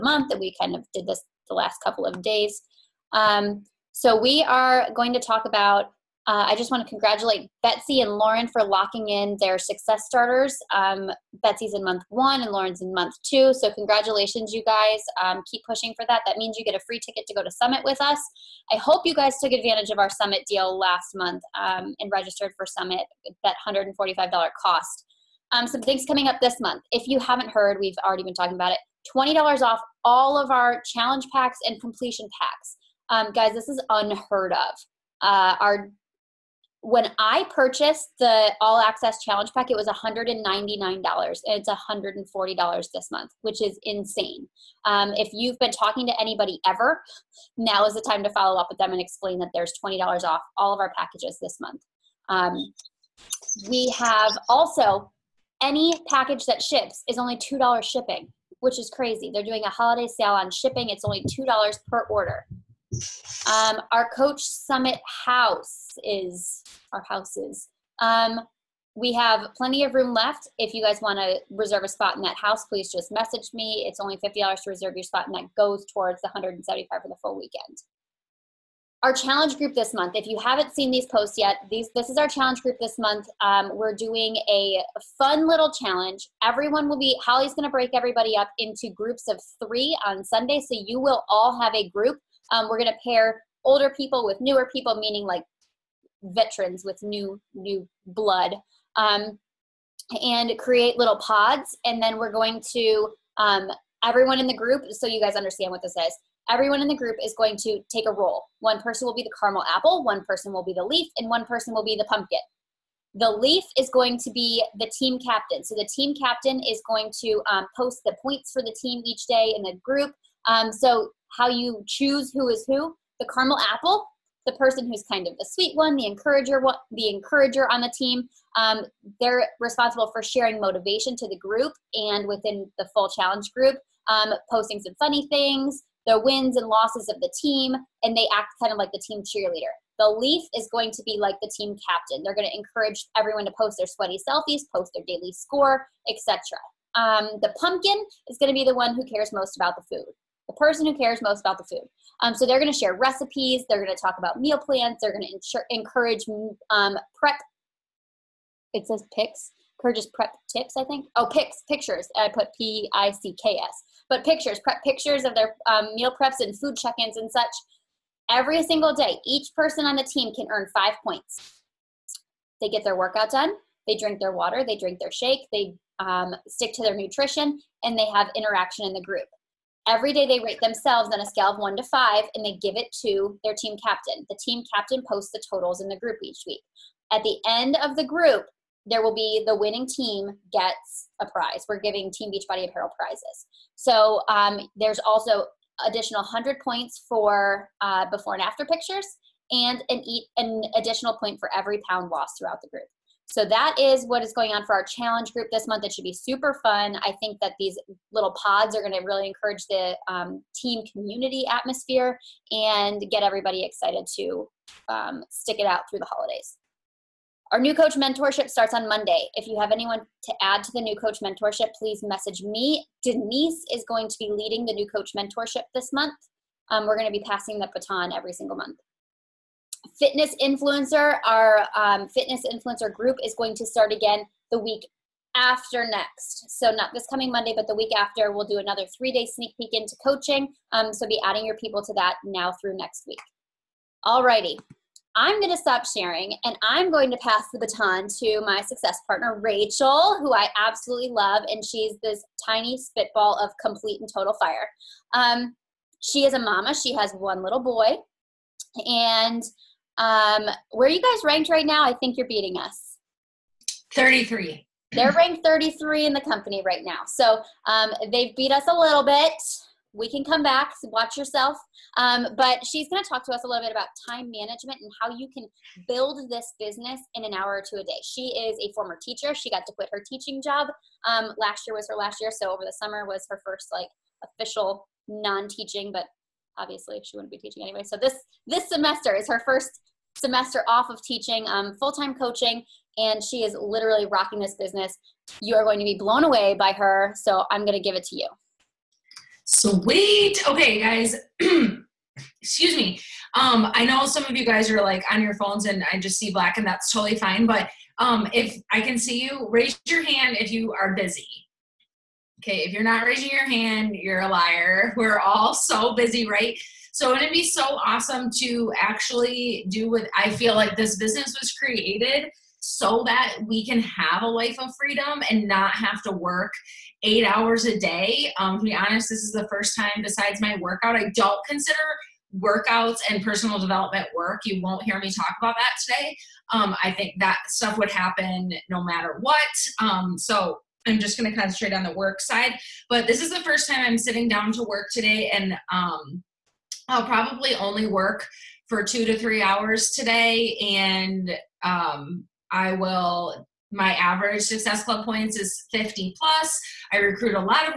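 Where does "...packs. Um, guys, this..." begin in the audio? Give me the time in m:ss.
0:32.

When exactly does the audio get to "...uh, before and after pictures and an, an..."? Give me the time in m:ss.
3:17.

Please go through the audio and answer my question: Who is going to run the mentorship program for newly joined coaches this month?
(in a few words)
Denise.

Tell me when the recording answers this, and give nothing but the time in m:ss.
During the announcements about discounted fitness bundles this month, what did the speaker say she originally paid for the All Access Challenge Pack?
0:39.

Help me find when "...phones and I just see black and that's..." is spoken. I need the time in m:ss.
5:05.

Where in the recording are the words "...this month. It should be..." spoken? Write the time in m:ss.
3:25.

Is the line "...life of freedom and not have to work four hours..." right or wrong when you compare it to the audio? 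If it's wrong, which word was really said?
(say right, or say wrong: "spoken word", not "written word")
wrong: "eight", not "four".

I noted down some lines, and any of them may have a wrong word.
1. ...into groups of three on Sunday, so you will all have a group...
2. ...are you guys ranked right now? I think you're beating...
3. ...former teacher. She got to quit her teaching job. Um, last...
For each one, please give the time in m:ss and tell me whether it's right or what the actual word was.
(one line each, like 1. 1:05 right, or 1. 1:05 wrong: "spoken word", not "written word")
1. 1:28 right
2. 4:20 right
3. 4:38 right.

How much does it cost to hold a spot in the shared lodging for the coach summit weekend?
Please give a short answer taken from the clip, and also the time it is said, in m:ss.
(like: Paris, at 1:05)
$50, at 1:14.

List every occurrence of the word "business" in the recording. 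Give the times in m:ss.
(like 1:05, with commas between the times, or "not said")
4:36, 4:54, 5:20.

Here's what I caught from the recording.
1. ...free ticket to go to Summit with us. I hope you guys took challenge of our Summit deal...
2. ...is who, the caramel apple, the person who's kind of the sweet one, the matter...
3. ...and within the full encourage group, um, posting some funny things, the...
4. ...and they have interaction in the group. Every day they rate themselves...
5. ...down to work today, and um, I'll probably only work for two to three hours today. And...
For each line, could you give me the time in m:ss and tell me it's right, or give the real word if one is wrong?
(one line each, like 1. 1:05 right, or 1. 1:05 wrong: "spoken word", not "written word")
1. 0:16 wrong: "advantage", not "challenge"
2. 2:02 wrong: "encourager", not "matter"
3. 2:11 wrong: "challenge", not "encourage"
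4. 2:57 right
5. 5:44 right.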